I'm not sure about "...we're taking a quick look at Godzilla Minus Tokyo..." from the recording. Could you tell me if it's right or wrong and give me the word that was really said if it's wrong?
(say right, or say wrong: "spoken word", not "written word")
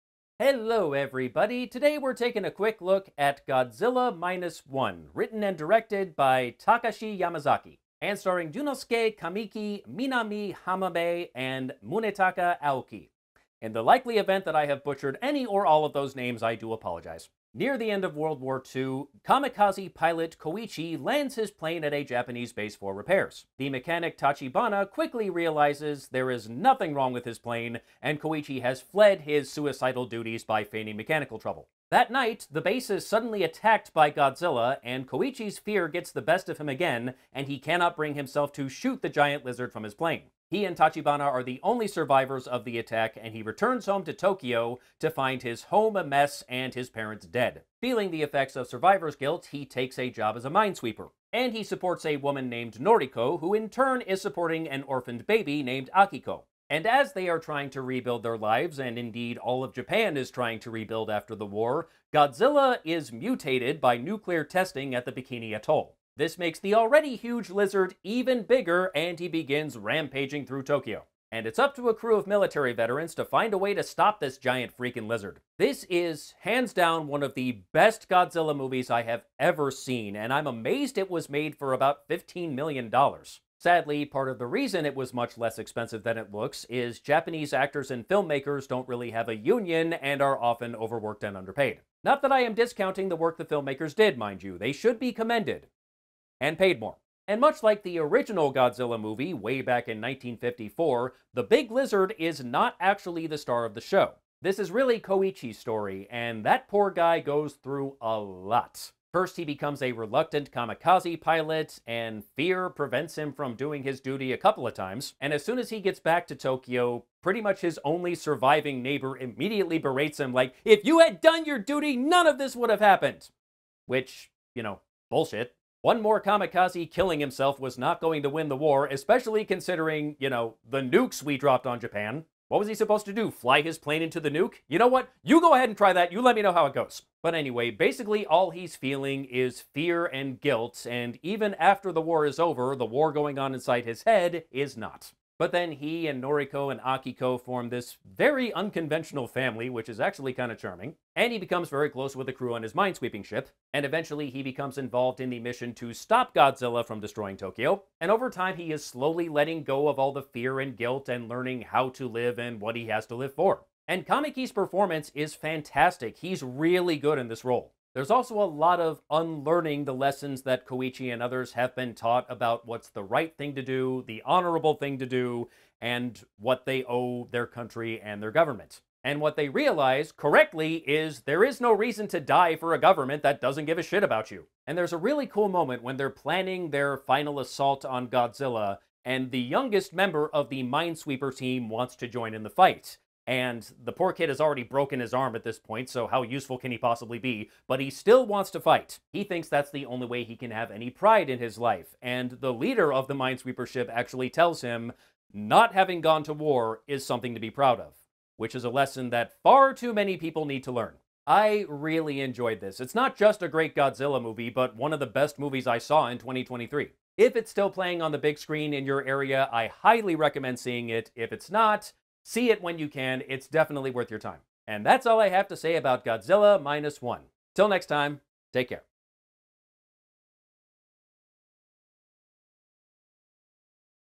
wrong: "One", not "Tokyo".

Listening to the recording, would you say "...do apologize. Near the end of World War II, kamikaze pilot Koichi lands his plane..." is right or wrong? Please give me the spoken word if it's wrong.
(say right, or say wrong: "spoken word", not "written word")
right.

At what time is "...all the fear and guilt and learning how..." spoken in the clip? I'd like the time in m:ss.
2:39.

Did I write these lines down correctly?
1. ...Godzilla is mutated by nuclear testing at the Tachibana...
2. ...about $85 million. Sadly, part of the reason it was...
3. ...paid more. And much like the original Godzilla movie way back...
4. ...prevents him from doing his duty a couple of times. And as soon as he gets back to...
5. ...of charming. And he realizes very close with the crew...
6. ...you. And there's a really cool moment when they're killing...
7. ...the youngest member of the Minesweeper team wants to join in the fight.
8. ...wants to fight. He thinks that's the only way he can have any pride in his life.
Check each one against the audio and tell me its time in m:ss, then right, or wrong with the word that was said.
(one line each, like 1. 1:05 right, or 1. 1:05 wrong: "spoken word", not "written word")
1. 1:02 wrong: "Bikini", not "Tachibana"
2. 1:21 wrong: "15", not "85"
3. 1:36 right
4. 1:52 right
5. 2:30 wrong: "becomes", not "realizes"
6. 3:04 wrong: "planning", not "killing"
7. 3:09 right
8. 3:18 right.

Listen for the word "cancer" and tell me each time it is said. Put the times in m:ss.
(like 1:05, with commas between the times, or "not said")
not said.